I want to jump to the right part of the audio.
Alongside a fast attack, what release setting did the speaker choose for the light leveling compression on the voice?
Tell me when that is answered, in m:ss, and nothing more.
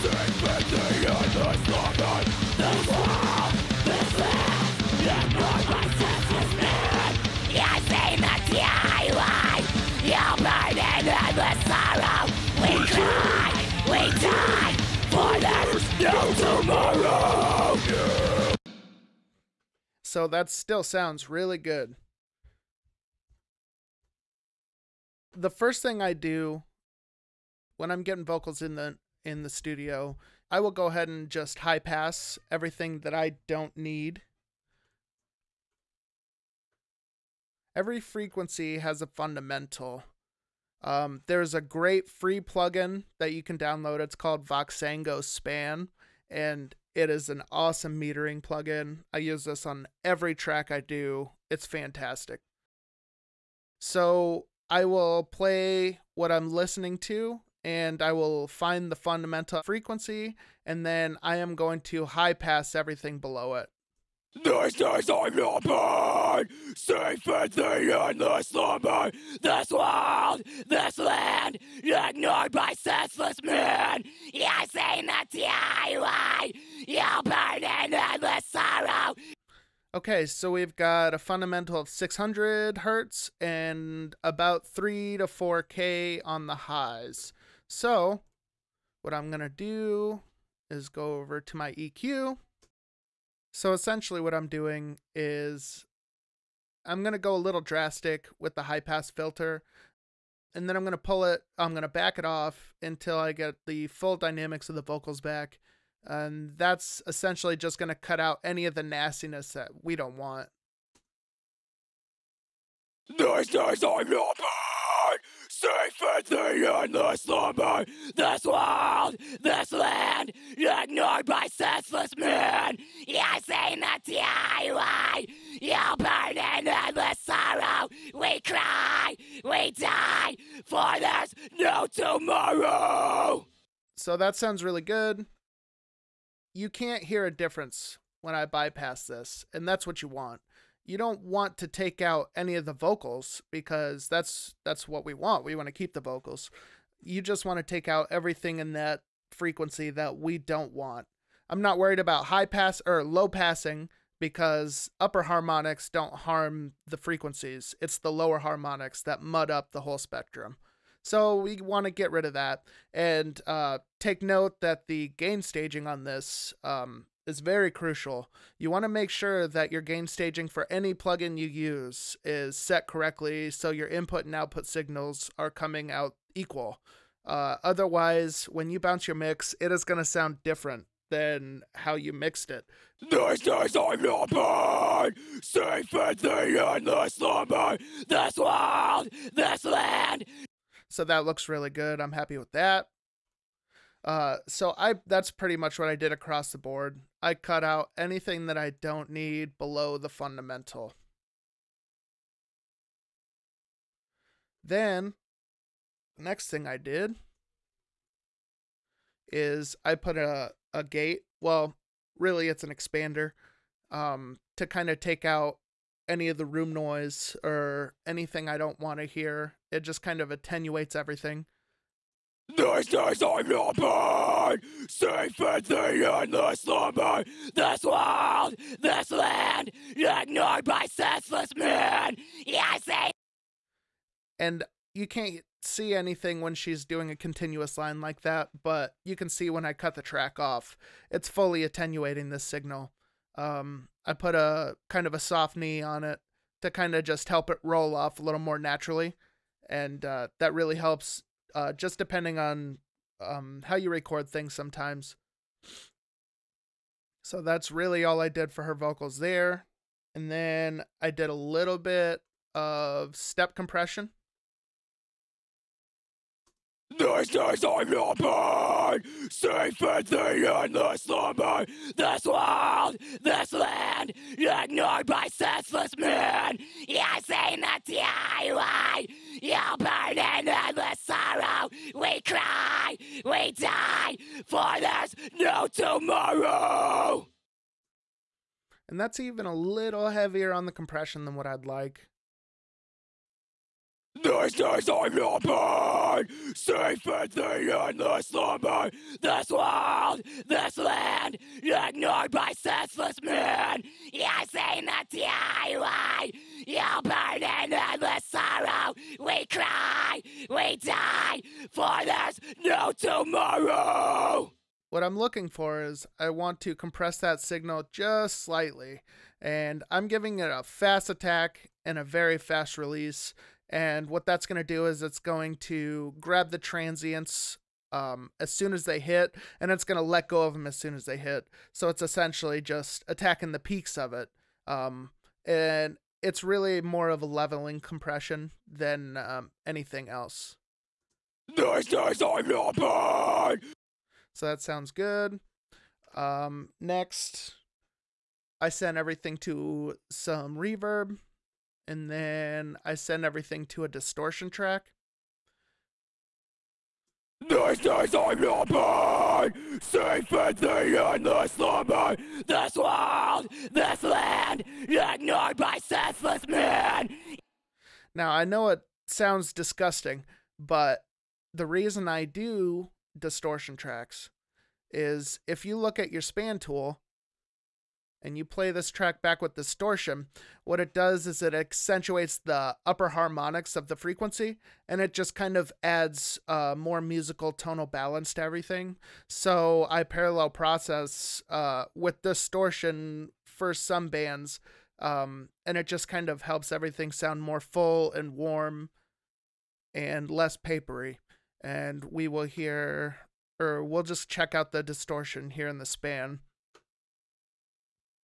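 5:22.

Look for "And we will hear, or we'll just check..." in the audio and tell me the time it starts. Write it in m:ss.
6:41.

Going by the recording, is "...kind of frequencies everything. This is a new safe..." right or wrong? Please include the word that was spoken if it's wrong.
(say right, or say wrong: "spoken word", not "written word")
wrong: "attenuates", not "frequencies".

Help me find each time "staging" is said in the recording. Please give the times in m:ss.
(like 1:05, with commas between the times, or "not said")
2:45, 2:50.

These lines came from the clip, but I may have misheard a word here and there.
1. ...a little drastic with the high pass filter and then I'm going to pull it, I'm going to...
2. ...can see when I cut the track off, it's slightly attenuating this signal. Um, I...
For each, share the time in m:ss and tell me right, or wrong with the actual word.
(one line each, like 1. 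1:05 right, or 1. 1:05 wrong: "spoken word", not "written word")
1. 1:37 right
2. 3:59 wrong: "fully", not "slightly".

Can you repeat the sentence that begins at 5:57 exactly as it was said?
This is Safe the endless This world!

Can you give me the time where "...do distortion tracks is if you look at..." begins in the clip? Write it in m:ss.
6:12.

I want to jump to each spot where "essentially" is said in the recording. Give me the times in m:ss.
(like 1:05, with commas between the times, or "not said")
1:33, 1:47, 5:32.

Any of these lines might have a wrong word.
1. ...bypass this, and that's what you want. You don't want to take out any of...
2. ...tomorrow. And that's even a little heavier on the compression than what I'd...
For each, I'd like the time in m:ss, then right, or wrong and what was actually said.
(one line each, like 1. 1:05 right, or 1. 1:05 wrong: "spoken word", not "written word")
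1. 2:18 right
2. 4:45 right.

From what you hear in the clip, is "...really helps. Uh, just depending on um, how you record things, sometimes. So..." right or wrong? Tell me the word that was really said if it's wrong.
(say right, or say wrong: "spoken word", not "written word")
right.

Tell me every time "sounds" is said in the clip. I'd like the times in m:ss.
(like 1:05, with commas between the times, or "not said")
0:20, 2:14, 3:00, 5:44, 6:09, 6:37.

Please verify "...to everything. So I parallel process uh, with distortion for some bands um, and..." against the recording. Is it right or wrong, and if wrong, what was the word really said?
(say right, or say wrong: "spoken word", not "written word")
right.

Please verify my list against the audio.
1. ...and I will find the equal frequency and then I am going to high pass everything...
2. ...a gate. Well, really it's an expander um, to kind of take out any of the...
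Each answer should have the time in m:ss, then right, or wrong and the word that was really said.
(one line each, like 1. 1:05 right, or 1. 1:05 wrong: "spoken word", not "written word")
1. 0:57 wrong: "fundamental", not "equal"
2. 3:30 right.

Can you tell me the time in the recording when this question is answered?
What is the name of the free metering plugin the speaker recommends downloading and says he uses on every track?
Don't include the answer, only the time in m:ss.
0:44.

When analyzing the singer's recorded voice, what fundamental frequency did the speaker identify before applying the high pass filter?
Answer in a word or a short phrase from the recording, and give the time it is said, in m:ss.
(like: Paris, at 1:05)
600 Hz, at 1:21.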